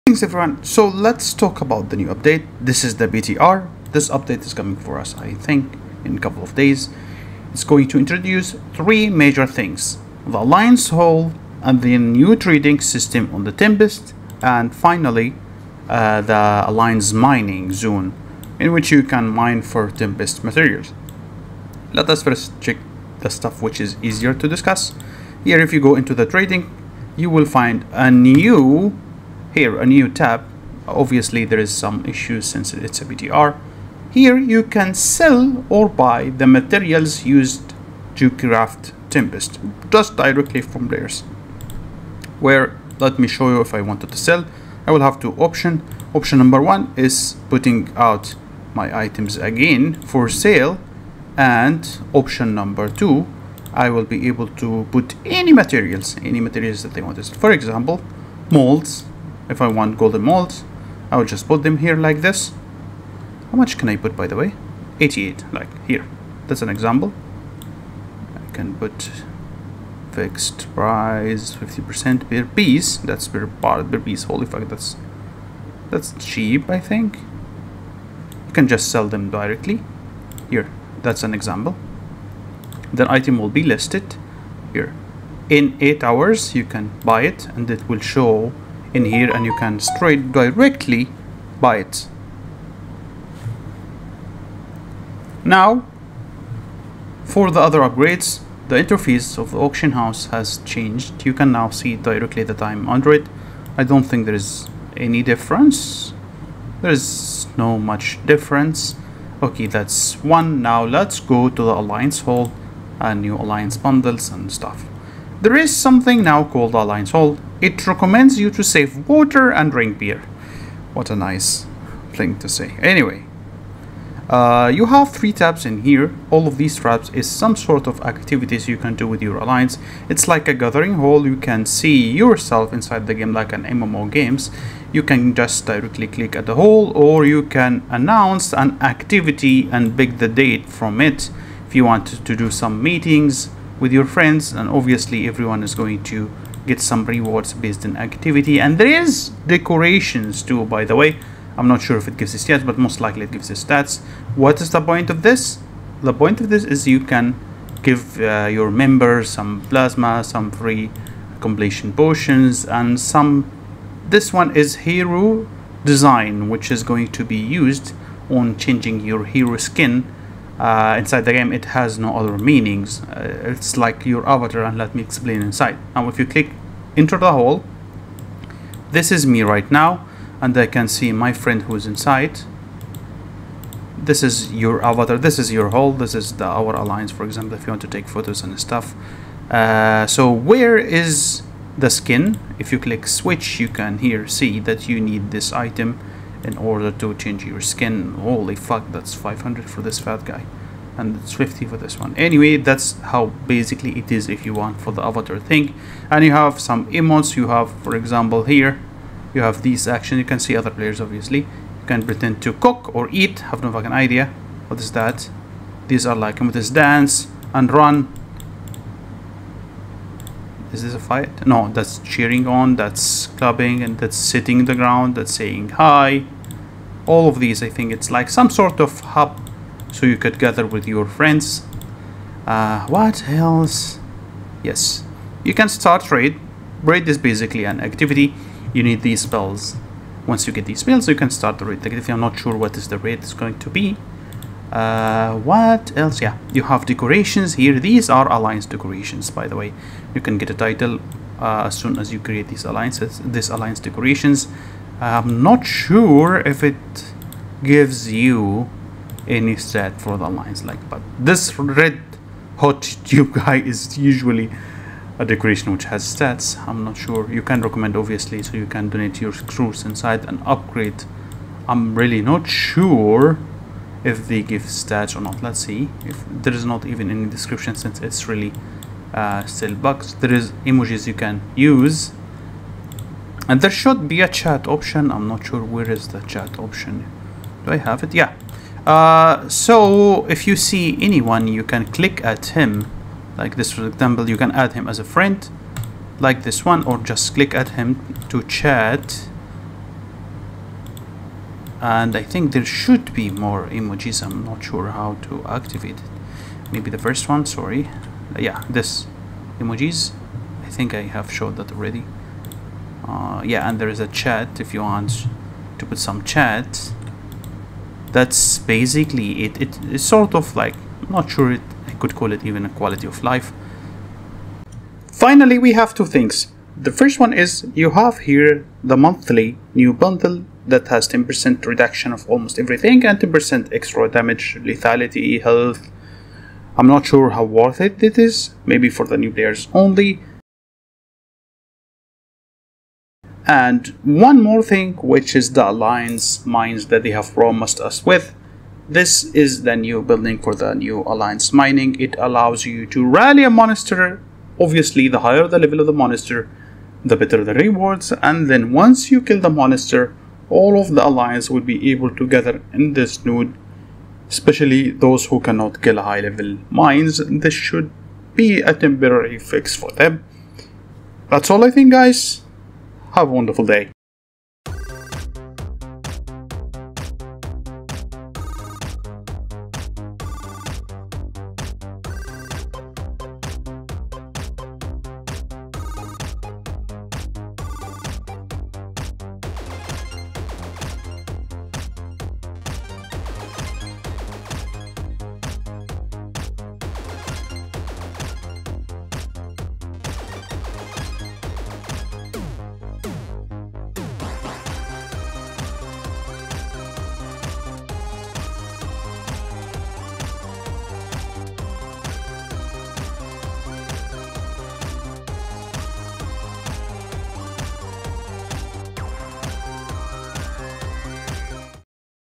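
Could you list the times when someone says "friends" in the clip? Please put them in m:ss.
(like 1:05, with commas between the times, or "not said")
2:24, 3:01, 3:51, 4:55.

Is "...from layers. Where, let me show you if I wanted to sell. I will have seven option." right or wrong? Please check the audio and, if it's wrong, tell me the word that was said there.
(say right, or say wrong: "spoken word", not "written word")
wrong: "two", not "seven".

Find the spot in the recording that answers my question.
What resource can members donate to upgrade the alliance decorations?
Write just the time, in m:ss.
4:29.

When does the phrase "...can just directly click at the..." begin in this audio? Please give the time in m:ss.
2:15.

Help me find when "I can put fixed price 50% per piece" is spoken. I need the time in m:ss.
1:08.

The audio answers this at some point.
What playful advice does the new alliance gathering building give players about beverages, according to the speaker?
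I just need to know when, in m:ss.
1:58.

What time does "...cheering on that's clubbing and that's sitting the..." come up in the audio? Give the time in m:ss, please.
3:41.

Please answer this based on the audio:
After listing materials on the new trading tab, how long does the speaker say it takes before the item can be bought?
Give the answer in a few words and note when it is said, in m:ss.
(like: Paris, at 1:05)
8 hours, at 1:25.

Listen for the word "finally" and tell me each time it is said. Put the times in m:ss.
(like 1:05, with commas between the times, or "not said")
0:14, 5:25.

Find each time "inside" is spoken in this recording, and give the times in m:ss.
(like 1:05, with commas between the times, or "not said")
2:12, 2:50, 2:55, 3:01, 4:29.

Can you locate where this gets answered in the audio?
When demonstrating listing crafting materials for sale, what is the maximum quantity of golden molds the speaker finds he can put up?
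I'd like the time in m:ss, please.
1:05.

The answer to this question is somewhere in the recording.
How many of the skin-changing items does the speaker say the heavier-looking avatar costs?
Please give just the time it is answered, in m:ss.
3:19.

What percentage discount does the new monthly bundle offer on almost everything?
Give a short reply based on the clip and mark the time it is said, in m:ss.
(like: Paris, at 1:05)
10%, at 5:31.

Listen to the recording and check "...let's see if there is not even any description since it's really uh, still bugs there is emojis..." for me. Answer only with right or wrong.
right.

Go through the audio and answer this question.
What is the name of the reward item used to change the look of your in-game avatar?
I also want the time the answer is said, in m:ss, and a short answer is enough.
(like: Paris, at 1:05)
Hero design, at 2:44.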